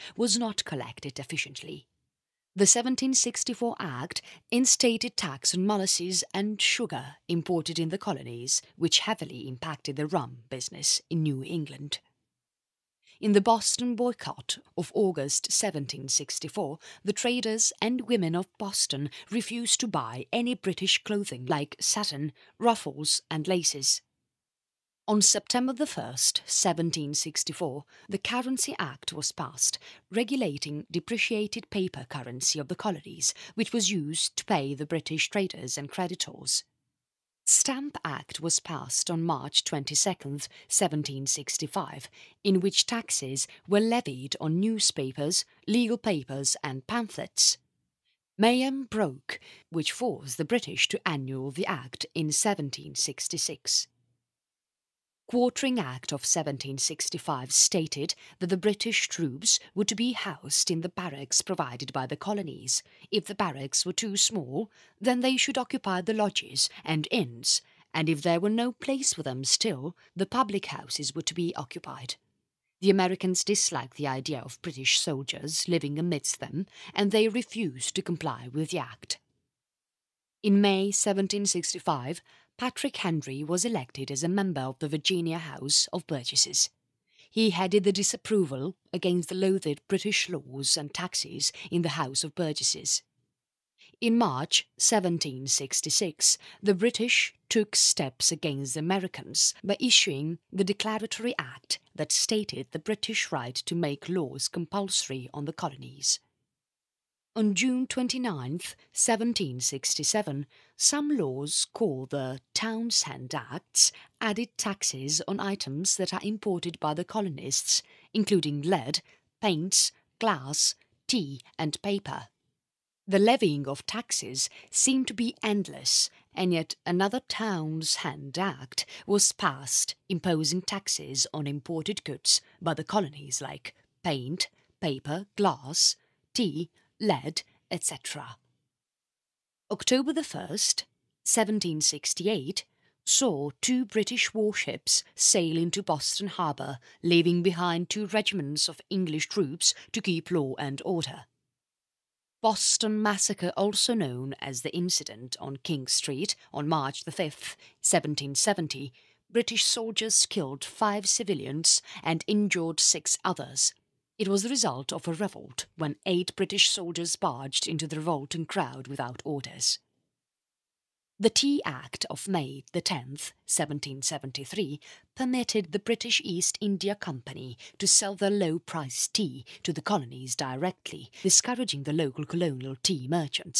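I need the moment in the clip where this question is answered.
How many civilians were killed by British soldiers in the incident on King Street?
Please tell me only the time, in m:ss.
2:40.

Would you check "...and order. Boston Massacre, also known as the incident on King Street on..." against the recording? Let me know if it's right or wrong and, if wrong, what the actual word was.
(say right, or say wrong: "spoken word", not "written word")
right.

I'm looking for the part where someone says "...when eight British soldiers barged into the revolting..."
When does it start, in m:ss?
2:45.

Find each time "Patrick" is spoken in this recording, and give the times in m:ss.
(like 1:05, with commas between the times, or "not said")
1:22.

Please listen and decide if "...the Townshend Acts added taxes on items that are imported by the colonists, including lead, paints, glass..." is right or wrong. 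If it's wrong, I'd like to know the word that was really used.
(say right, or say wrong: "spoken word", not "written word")
right.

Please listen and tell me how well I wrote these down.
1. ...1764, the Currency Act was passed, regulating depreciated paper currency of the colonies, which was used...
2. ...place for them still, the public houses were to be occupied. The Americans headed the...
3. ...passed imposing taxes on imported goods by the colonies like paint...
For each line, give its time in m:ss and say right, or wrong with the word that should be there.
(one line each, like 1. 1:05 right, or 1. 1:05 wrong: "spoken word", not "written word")
1. 0:26 right
2. 1:08 wrong: "disliked", not "headed"
3. 2:09 right.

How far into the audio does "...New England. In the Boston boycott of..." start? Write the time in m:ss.
0:11.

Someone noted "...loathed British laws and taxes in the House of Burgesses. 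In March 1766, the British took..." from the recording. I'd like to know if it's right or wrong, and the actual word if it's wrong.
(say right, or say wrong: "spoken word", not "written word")
right.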